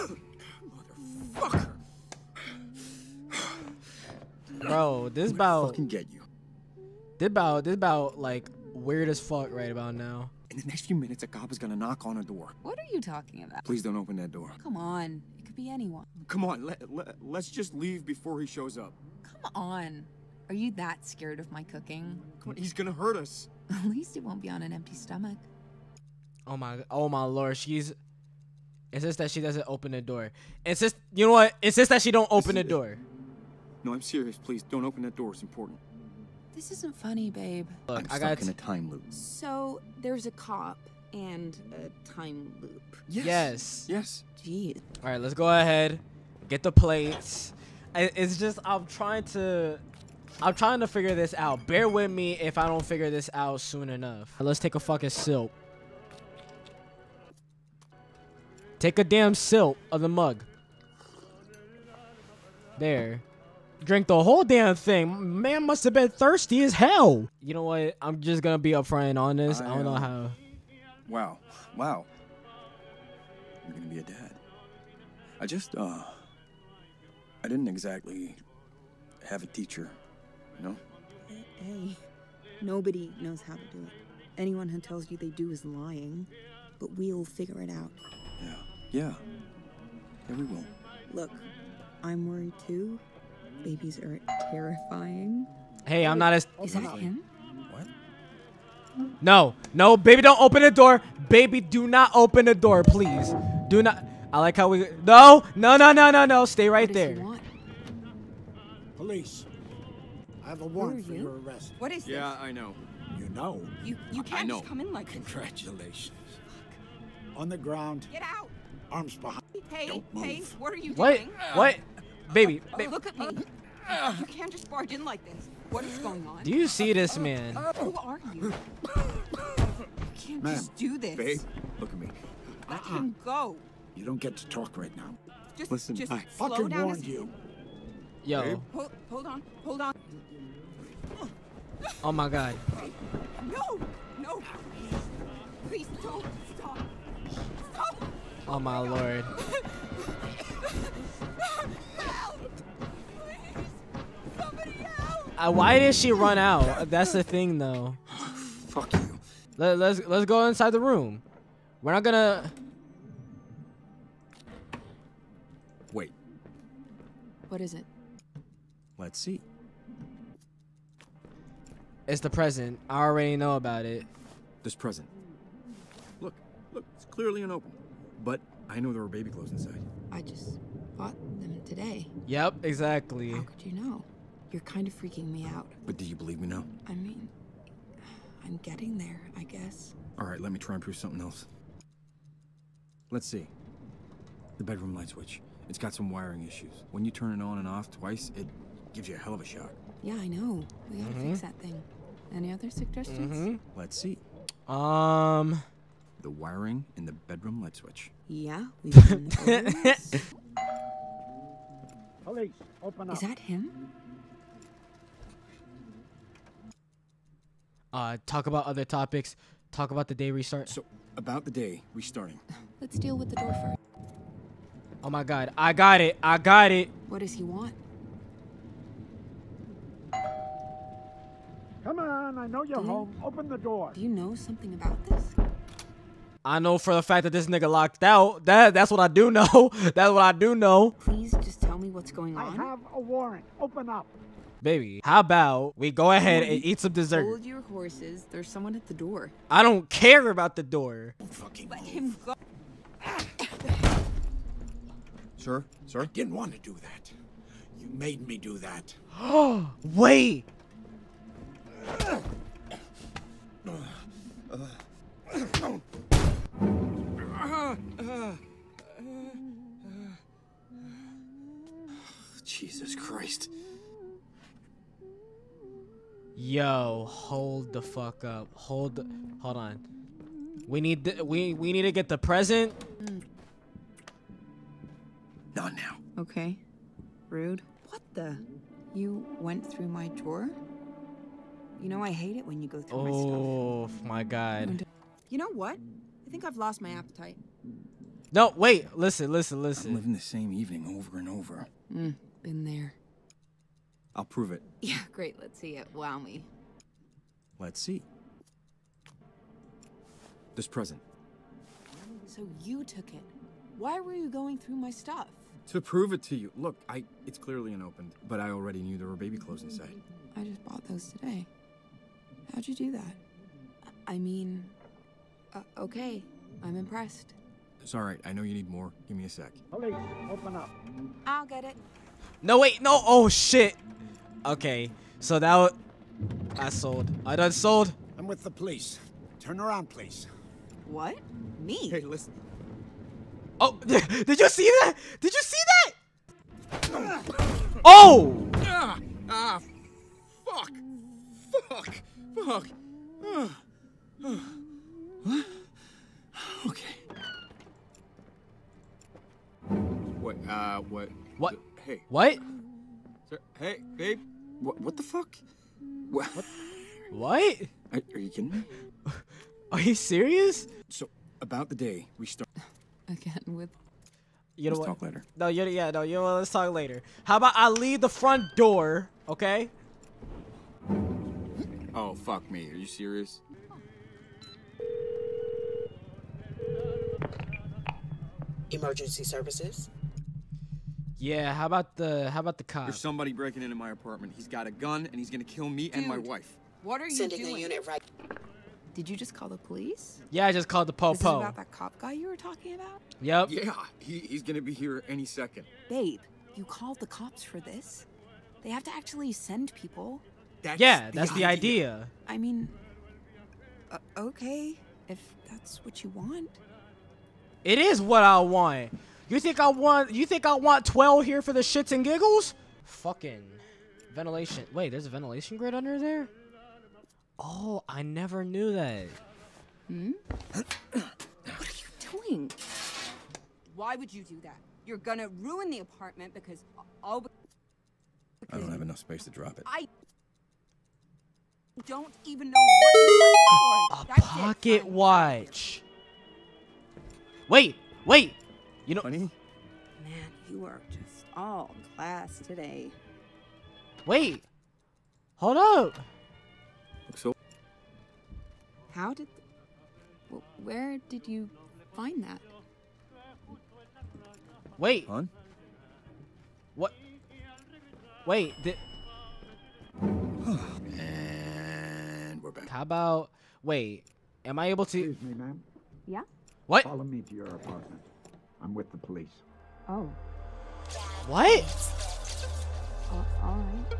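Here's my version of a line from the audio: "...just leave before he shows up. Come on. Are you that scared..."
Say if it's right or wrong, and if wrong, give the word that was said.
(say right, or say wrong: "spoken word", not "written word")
right.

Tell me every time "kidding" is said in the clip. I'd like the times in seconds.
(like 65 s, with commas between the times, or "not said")
368 s.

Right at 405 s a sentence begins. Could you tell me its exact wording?
Babe, you called the cops for this?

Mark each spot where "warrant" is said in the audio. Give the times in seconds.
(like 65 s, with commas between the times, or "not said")
110 s, 242 s.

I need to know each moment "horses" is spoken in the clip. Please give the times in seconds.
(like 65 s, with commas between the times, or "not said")
247 s.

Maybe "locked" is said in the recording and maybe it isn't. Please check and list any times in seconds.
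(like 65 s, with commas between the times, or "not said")
237 s.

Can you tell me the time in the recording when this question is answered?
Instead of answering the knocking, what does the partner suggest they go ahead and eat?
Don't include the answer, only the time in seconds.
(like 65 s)
246 s.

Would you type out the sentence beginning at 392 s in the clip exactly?
There's somebody breaking into my apartment.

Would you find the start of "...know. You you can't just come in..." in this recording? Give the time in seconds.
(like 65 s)
113 s.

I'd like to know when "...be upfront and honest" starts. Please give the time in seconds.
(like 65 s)
68 s.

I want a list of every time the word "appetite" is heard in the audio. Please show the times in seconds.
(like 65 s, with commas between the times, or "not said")
296 s.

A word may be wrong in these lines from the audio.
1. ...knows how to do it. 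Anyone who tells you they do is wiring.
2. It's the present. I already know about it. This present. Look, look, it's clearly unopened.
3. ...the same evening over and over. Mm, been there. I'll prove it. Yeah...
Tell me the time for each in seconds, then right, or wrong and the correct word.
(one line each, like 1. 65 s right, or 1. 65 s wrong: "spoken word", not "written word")
1. 83 s wrong: "lying", not "wiring"
2. 172 s right
3. 300 s right.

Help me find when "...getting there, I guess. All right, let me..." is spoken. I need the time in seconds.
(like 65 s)
188 s.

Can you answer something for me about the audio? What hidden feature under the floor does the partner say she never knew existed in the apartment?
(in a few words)
ventilation grid.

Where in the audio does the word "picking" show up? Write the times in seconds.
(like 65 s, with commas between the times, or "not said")
not said.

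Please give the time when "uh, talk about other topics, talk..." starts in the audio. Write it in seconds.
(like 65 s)
217 s.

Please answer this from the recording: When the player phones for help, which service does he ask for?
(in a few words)
Emergency services.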